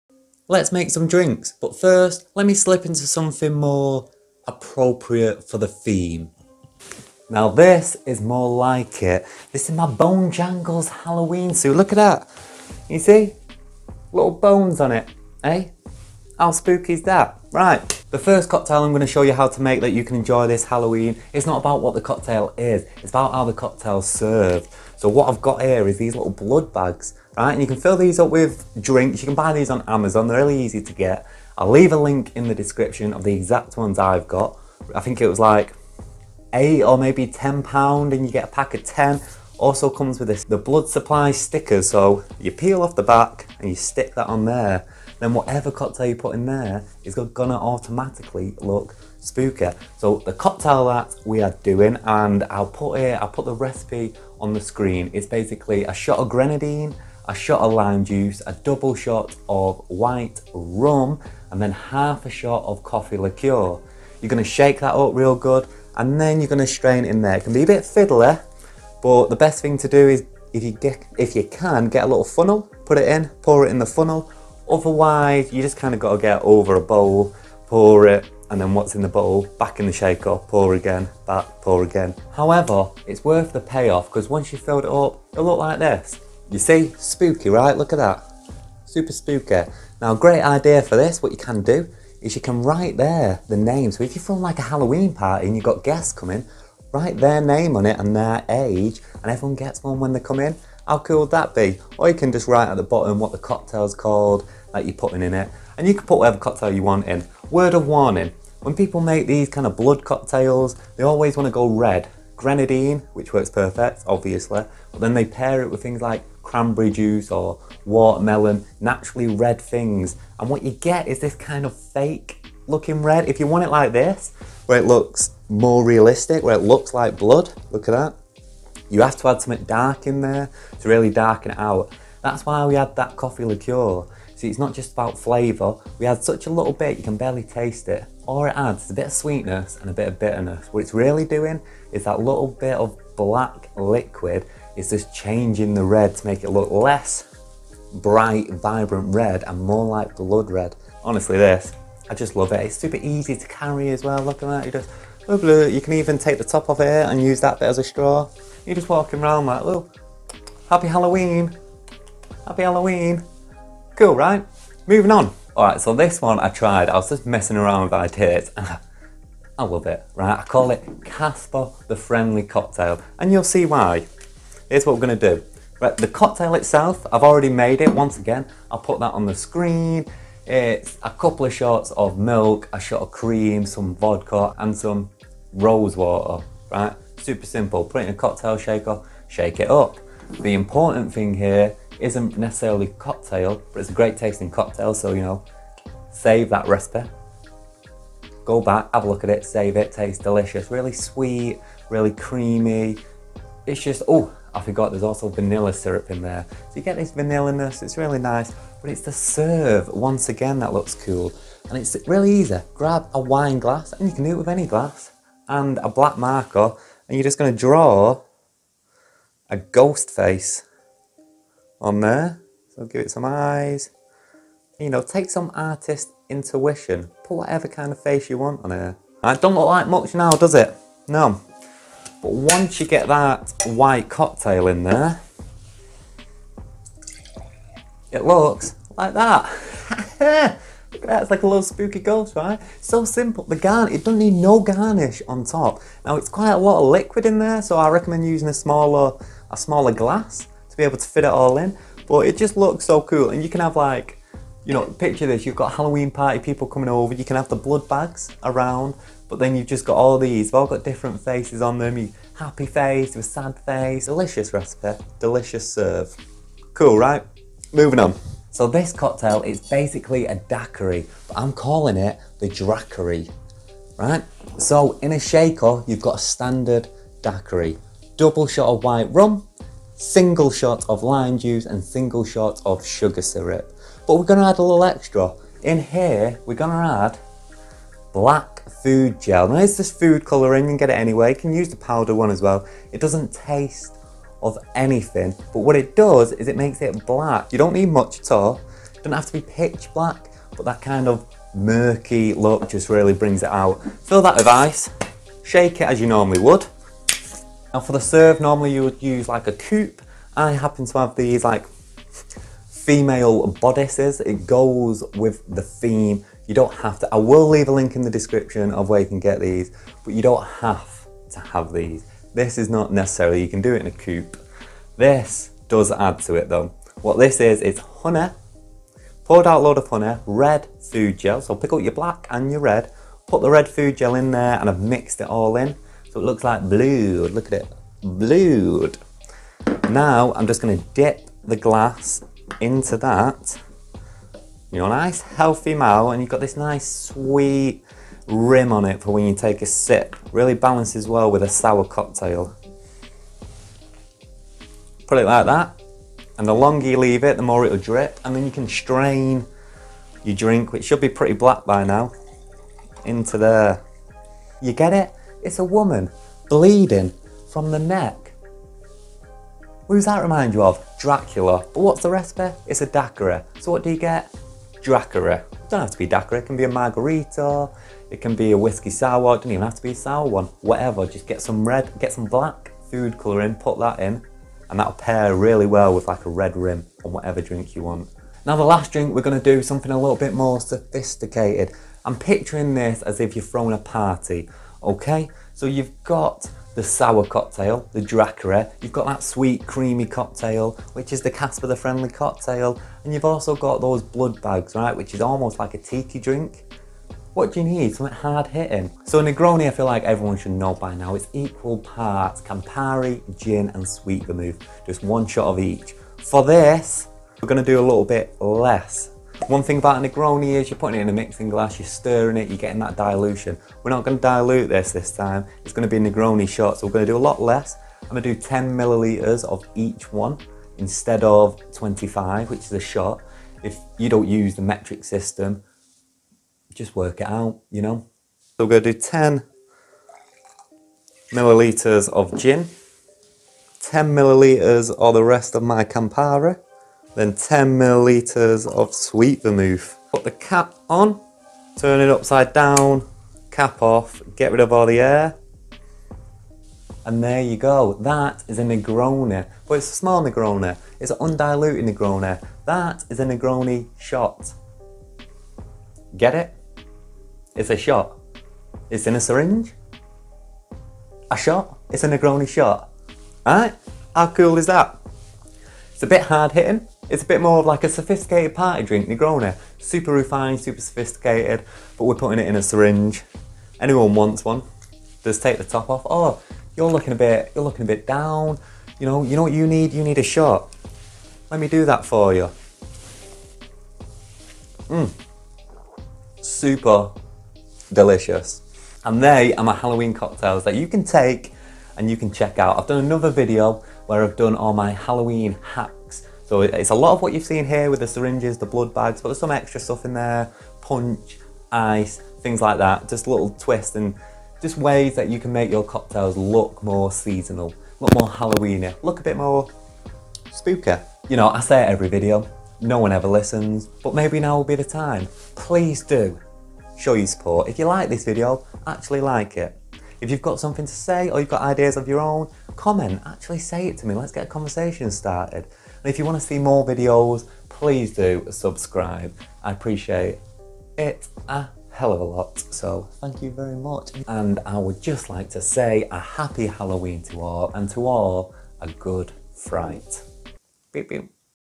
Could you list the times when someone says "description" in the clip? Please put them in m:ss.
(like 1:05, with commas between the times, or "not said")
0:32, 5:18.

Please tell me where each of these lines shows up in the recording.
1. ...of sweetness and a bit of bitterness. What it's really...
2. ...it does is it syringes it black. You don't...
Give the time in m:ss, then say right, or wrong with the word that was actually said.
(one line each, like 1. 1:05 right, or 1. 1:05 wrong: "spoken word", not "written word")
1. 2:19 right
2. 4:55 wrong: "makes", not "syringes".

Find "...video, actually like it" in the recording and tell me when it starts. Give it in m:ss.
8:48.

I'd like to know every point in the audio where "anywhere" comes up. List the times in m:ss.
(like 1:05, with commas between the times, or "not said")
4:50.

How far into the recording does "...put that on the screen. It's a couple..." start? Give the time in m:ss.
2:58.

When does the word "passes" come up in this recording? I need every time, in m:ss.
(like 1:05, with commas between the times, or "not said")
not said.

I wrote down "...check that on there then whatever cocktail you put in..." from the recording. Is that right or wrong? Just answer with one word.
wrong.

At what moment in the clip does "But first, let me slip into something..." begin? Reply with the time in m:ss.
0:01.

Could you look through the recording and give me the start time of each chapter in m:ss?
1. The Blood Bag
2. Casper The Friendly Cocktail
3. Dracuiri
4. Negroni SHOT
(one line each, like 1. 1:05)
1. 0:18
2. 2:45
3. 4:28
4. 6:48.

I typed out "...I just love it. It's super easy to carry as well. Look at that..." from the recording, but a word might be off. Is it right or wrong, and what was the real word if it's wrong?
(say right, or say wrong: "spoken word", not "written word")
right.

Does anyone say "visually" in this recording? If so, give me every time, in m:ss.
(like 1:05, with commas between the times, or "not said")
not said.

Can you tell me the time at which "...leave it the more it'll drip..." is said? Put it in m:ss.
5:56.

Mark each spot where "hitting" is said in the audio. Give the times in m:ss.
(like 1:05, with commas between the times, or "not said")
6:48, 7:56.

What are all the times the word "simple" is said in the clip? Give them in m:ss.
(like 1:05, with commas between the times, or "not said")
3:07, 4:03.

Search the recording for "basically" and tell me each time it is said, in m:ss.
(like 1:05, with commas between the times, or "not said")
0:55, 4:29.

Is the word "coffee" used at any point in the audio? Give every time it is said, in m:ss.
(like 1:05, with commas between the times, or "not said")
1:02, 2:13.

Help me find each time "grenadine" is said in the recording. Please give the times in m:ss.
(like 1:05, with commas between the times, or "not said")
0:56, 1:52.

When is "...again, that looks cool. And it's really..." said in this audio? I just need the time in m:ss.
3:30.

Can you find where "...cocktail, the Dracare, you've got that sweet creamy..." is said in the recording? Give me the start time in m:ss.
6:37.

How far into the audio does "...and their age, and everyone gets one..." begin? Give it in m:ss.
1:37.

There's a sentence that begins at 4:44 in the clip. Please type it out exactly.
But we're gonna add a little extra.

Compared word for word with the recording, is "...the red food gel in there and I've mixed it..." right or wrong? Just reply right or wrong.
right.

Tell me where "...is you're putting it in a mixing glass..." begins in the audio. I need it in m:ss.
7:00.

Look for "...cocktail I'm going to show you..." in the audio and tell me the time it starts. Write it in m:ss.
0:18.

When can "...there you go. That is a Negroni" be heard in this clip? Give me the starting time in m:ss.
7:37.